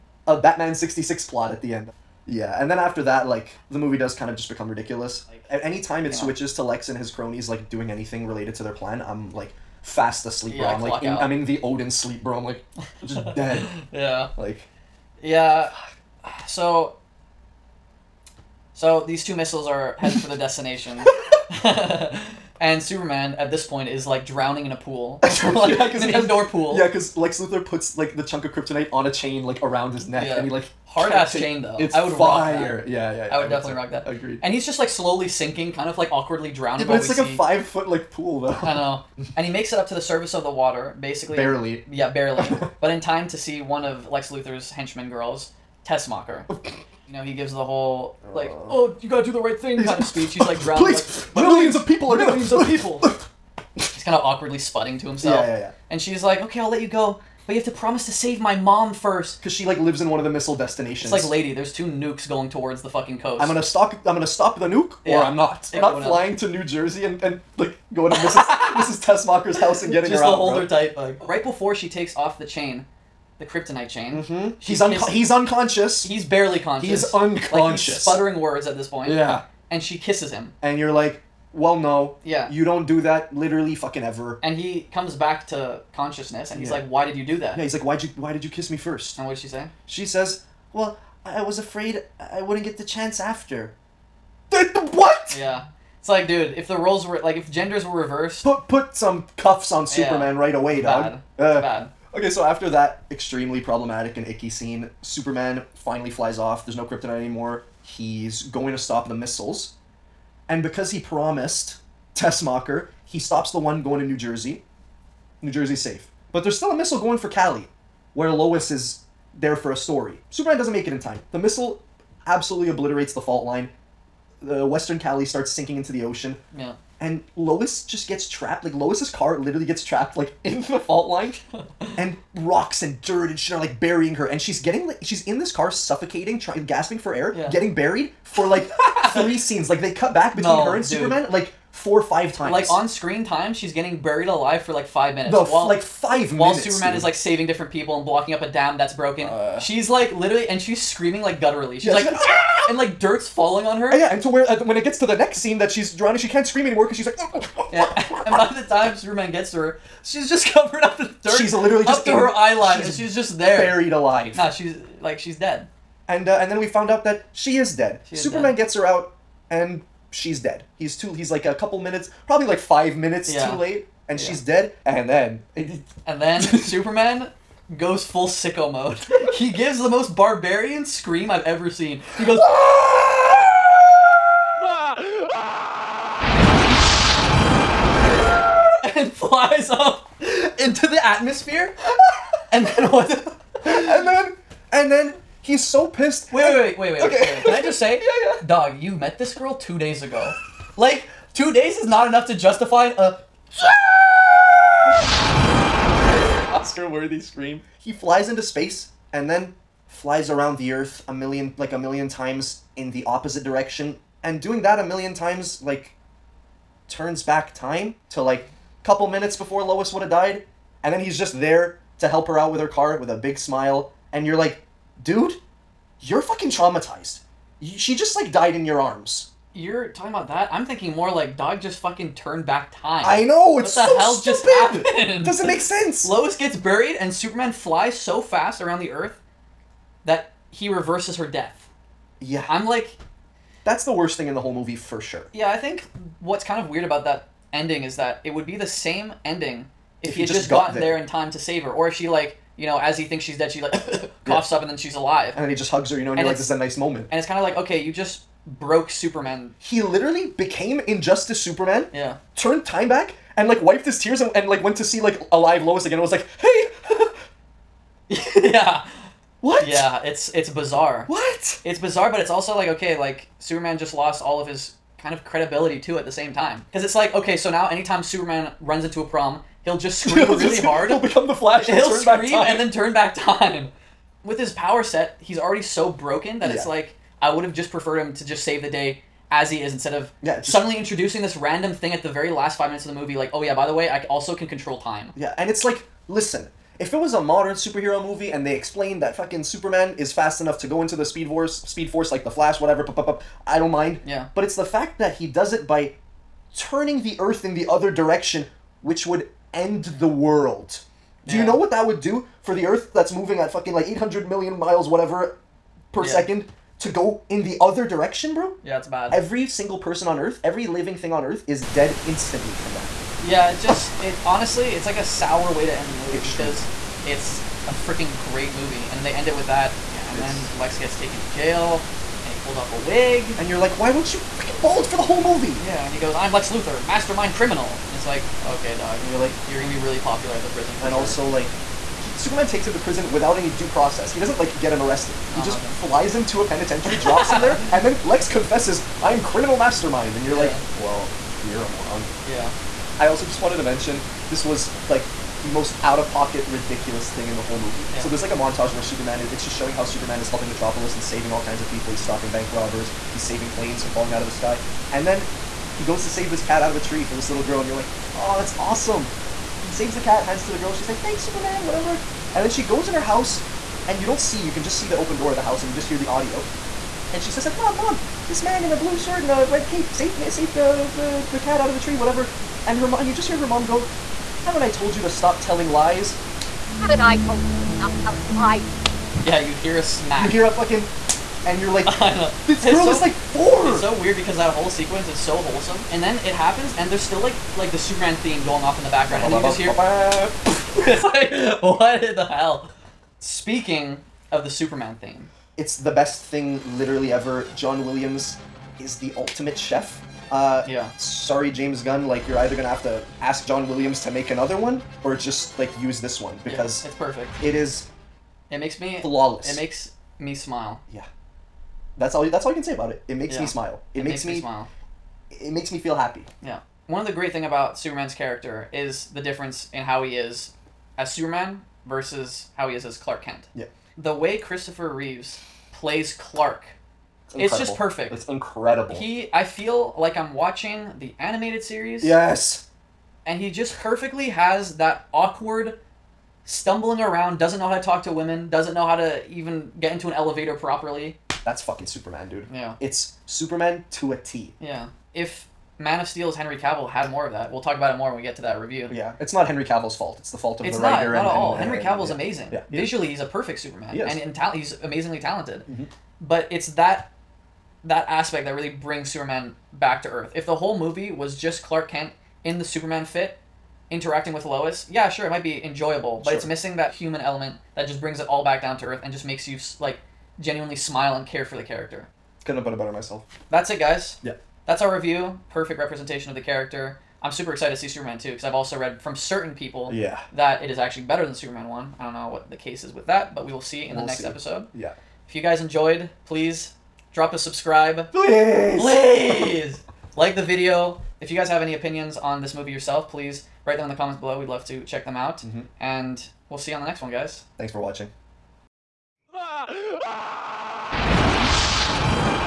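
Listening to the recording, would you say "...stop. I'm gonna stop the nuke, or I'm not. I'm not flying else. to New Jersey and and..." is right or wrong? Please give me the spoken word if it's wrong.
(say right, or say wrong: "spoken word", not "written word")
right.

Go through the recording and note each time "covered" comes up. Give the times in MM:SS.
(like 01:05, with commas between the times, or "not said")
02:40.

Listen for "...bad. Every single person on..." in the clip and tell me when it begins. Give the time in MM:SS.
05:18.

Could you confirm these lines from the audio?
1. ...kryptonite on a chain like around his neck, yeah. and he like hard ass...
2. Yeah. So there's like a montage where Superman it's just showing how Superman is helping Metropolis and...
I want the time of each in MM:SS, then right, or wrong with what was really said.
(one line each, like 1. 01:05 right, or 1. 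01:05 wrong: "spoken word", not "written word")
1. 00:28 right
2. 05:57 right.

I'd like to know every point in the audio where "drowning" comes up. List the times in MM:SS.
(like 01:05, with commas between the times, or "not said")
00:24, 00:36, 00:50, 02:35.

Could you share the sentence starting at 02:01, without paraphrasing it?
The missile absolutely obliterates the fault line.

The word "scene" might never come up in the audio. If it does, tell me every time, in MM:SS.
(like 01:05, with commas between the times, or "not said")
01:44, 02:19, 02:35.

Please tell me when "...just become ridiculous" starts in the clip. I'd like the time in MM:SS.
00:04.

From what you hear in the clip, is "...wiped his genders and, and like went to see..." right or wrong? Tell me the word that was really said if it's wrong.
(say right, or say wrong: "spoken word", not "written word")
wrong: "tears", not "genders".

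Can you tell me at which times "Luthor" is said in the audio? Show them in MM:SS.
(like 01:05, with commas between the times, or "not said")
00:27, 00:44, 05:36.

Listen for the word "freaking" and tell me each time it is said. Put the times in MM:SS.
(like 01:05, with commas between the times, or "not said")
05:27, 05:34.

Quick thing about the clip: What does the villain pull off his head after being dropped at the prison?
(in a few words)
a wig.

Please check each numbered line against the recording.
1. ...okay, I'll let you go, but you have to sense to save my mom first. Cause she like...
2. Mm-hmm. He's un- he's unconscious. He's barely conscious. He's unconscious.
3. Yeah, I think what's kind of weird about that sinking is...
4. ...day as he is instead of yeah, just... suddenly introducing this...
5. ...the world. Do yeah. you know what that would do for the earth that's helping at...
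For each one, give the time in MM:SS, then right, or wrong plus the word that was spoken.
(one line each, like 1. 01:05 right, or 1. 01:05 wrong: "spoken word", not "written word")
1. 00:56 wrong: "promise", not "sense"
2. 01:14 right
3. 04:05 wrong: "ending", not "sinking"
4. 04:48 right
5. 05:09 wrong: "moving", not "helping".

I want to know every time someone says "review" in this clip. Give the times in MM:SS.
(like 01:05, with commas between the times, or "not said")
07:38, 08:04.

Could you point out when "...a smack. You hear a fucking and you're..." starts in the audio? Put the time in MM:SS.
06:29.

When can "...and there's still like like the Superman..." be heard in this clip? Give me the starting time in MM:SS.
06:36.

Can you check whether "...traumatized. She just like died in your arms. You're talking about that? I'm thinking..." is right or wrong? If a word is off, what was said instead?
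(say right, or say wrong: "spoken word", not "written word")
right.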